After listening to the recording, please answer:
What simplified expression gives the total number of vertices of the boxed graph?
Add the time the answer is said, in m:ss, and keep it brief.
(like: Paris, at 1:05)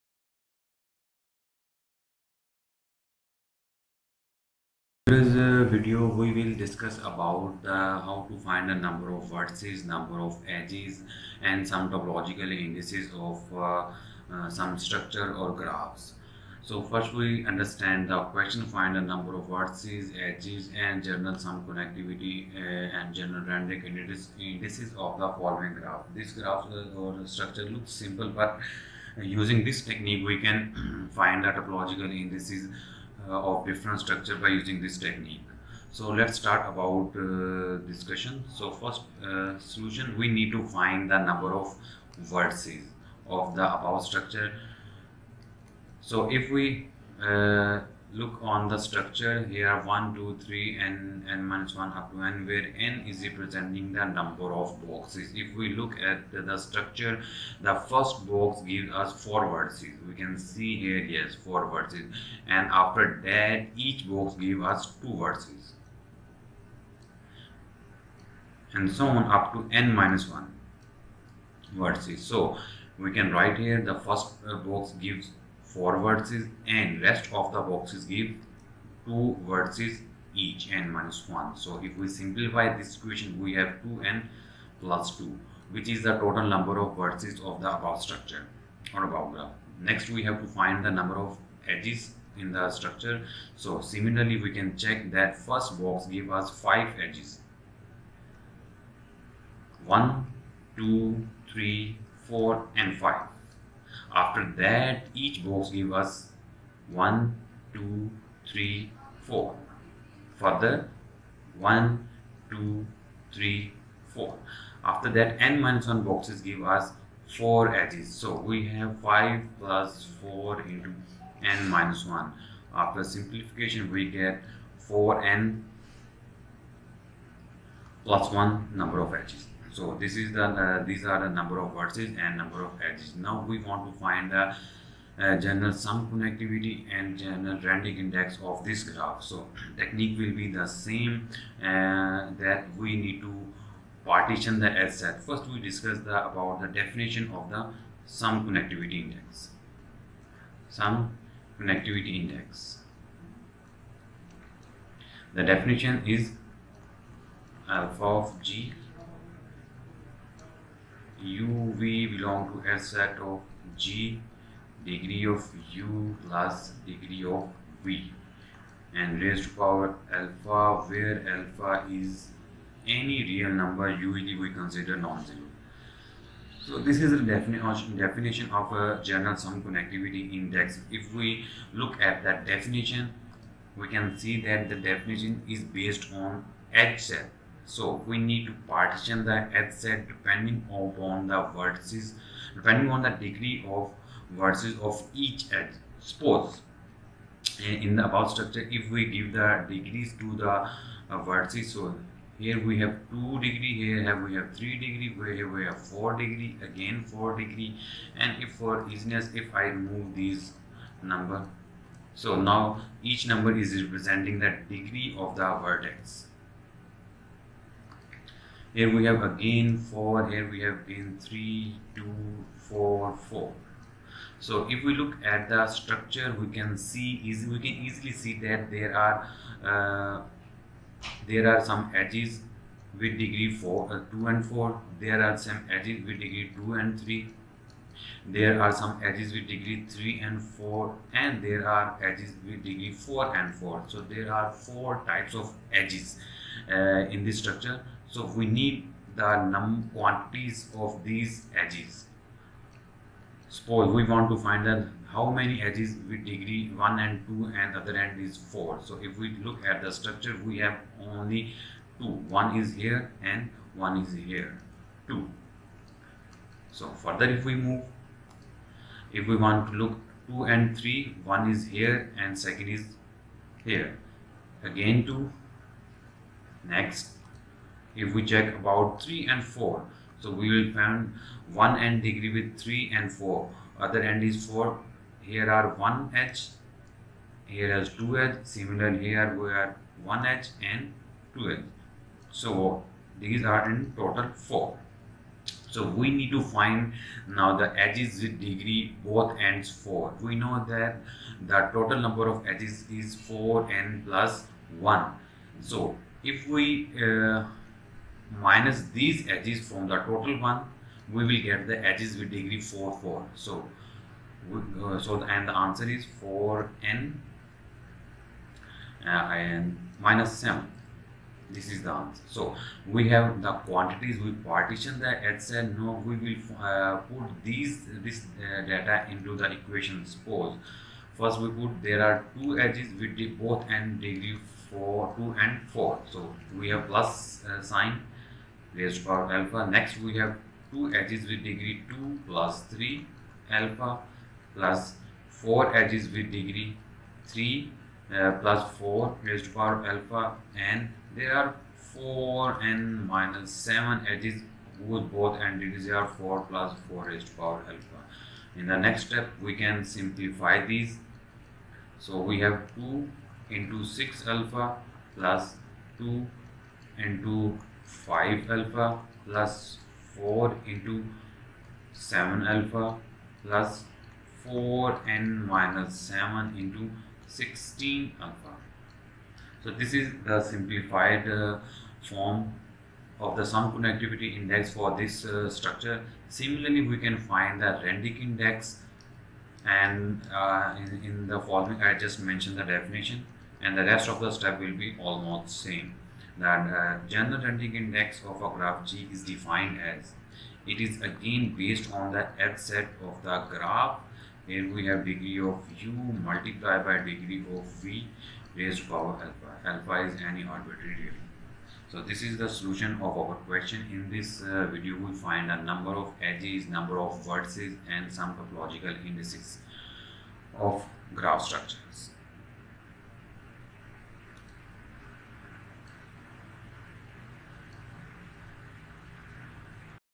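2n + 2, at 1:23.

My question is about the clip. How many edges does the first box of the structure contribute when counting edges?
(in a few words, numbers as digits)
5.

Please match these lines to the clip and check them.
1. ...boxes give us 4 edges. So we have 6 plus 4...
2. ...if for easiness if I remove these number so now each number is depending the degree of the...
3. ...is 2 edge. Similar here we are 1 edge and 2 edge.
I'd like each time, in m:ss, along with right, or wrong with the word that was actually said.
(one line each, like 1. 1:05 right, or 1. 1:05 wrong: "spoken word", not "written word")
1. 1:56 wrong: "5", not "6"
2. 3:28 wrong: "representing", not "depending"
3. 4:47 right.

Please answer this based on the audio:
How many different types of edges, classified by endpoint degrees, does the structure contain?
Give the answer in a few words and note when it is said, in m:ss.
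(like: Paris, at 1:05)
4, at 4:04.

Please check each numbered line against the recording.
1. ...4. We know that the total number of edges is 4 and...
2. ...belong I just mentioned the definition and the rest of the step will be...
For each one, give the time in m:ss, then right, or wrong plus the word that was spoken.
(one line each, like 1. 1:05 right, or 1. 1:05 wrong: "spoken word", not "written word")
1. 4:59 right
2. 6:31 wrong: "following", not "belong".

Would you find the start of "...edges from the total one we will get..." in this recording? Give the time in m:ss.
5:09.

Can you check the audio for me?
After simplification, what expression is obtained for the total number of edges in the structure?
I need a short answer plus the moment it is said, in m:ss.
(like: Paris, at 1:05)
4n + 1, at 2:04.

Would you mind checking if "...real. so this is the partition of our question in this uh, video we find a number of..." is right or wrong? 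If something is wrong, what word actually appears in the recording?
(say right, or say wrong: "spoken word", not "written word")
wrong: "solution", not "partition".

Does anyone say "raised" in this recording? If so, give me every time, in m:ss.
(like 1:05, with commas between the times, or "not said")
2:49, 5:38, 5:49, 5:57, 6:48.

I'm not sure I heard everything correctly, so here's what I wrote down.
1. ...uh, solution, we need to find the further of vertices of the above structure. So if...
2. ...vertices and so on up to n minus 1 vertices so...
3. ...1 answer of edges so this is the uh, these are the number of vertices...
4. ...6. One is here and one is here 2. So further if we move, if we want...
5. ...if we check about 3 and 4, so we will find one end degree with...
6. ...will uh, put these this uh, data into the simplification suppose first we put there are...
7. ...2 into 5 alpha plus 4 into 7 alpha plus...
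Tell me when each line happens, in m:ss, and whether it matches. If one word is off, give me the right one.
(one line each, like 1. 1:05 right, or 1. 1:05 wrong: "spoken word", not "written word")
1. 0:39 wrong: "number", not "further"
2. 1:05 right
3. 2:08 wrong: "number", not "answer"
4. 4:21 wrong: "2", not "6"
5. 4:37 right
6. 5:26 wrong: "equation", not "simplification"
7. 6:05 right.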